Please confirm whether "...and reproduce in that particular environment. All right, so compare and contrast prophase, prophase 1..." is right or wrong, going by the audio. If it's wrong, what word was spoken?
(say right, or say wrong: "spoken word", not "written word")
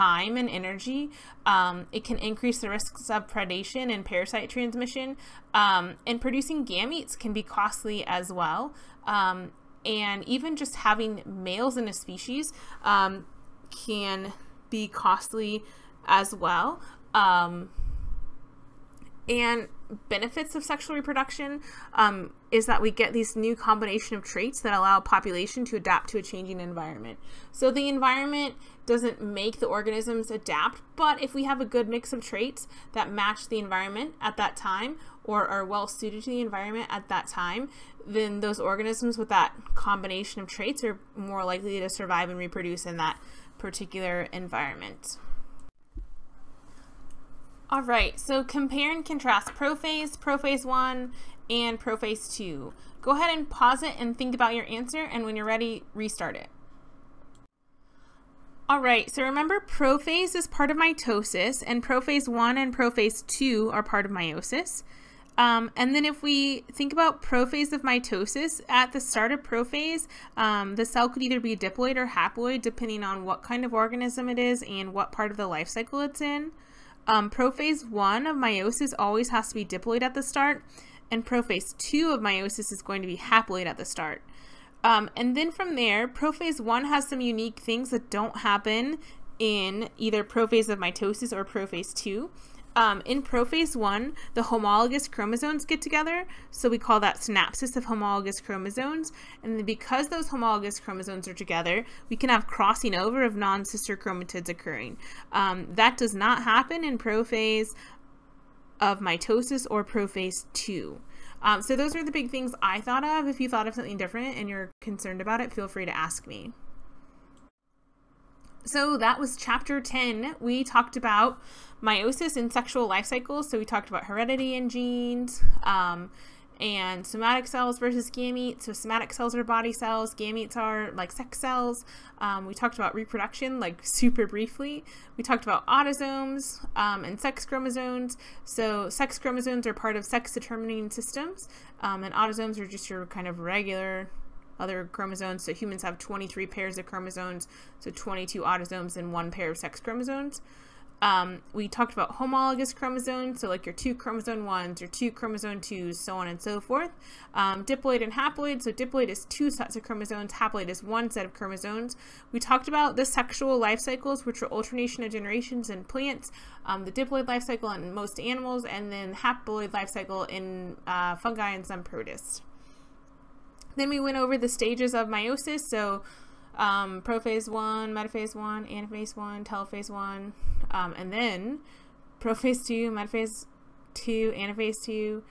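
right.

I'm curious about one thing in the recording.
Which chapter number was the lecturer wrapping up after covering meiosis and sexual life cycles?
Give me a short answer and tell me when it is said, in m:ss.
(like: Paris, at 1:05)
10, at 1:59.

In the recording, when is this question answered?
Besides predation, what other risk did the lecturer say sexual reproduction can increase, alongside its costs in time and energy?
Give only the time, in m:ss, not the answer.
0:04.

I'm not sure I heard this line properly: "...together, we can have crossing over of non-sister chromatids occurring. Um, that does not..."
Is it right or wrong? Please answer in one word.
right.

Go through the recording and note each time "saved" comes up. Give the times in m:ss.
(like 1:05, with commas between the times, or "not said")
not said.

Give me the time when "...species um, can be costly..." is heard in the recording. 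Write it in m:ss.
0:11.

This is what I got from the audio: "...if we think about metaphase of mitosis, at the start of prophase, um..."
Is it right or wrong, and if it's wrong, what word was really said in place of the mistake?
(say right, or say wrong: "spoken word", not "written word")
wrong: "prophase", not "metaphase".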